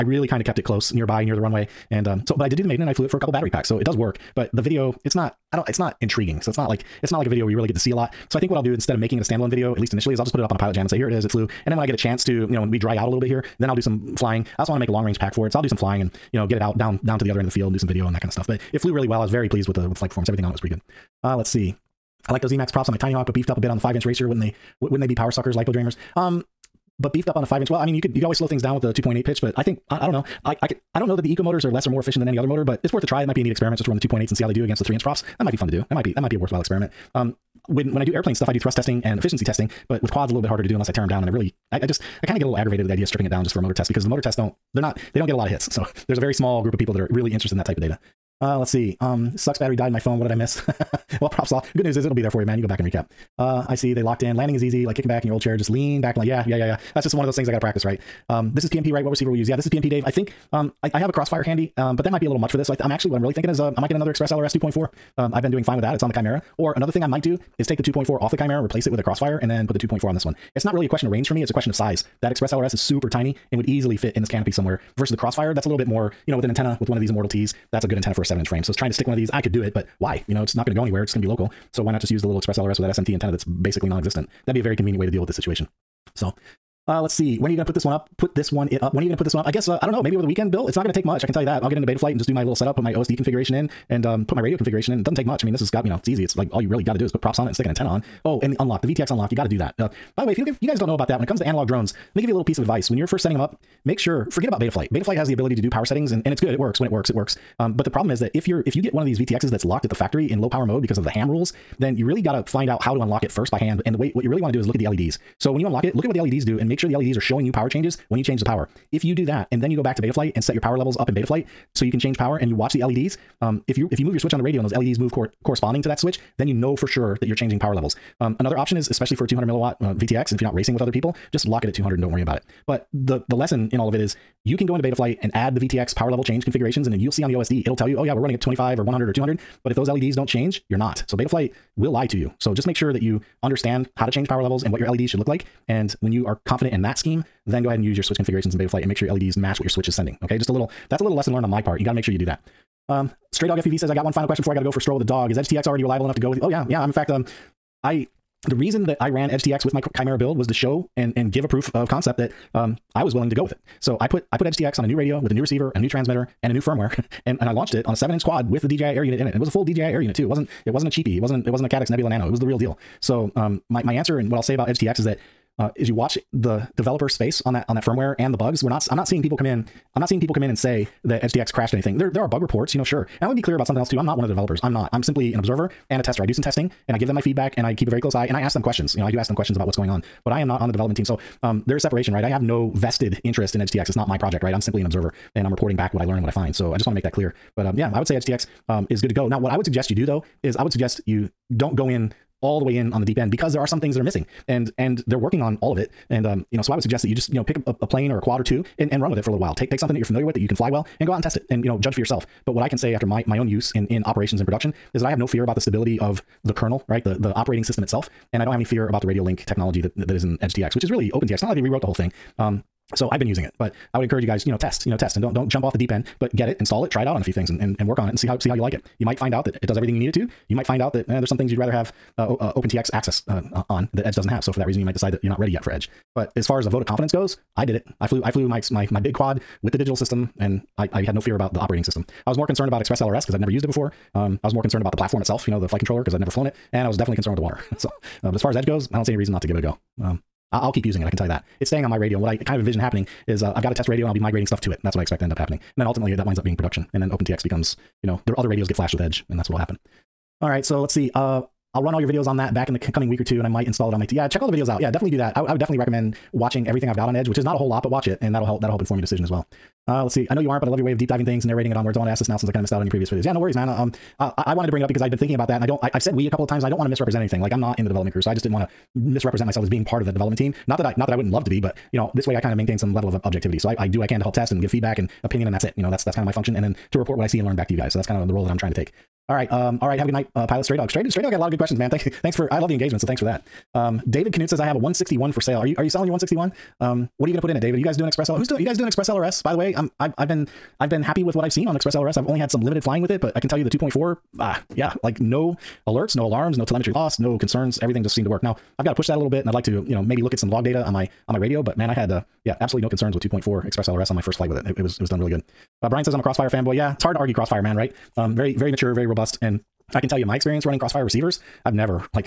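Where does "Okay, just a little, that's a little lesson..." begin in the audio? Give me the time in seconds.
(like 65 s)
150 s.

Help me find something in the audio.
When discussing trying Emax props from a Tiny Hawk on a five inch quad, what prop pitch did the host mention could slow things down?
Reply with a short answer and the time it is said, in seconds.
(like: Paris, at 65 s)
2.8, at 28 s.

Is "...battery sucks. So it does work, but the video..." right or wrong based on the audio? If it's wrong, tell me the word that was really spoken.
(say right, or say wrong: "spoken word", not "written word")
wrong: "packs", not "sucks".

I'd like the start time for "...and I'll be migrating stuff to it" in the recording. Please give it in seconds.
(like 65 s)
254 s.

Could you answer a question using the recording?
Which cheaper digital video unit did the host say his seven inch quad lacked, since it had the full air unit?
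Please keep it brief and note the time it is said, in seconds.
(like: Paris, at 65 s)
Caddx Nebula Nano, at 171 s.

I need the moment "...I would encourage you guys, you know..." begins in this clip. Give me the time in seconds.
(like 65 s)
223 s.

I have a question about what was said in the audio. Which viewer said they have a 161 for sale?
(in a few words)
David Knut.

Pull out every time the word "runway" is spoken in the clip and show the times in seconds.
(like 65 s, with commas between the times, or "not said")
1 s.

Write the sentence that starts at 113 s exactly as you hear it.
And the way, what you really want to do is look at the LEDs.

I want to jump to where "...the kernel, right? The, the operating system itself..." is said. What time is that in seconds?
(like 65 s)
216 s.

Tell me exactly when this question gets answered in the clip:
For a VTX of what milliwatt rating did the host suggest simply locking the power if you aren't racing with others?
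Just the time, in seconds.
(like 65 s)
129 s.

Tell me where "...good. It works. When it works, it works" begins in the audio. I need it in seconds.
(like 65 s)
106 s.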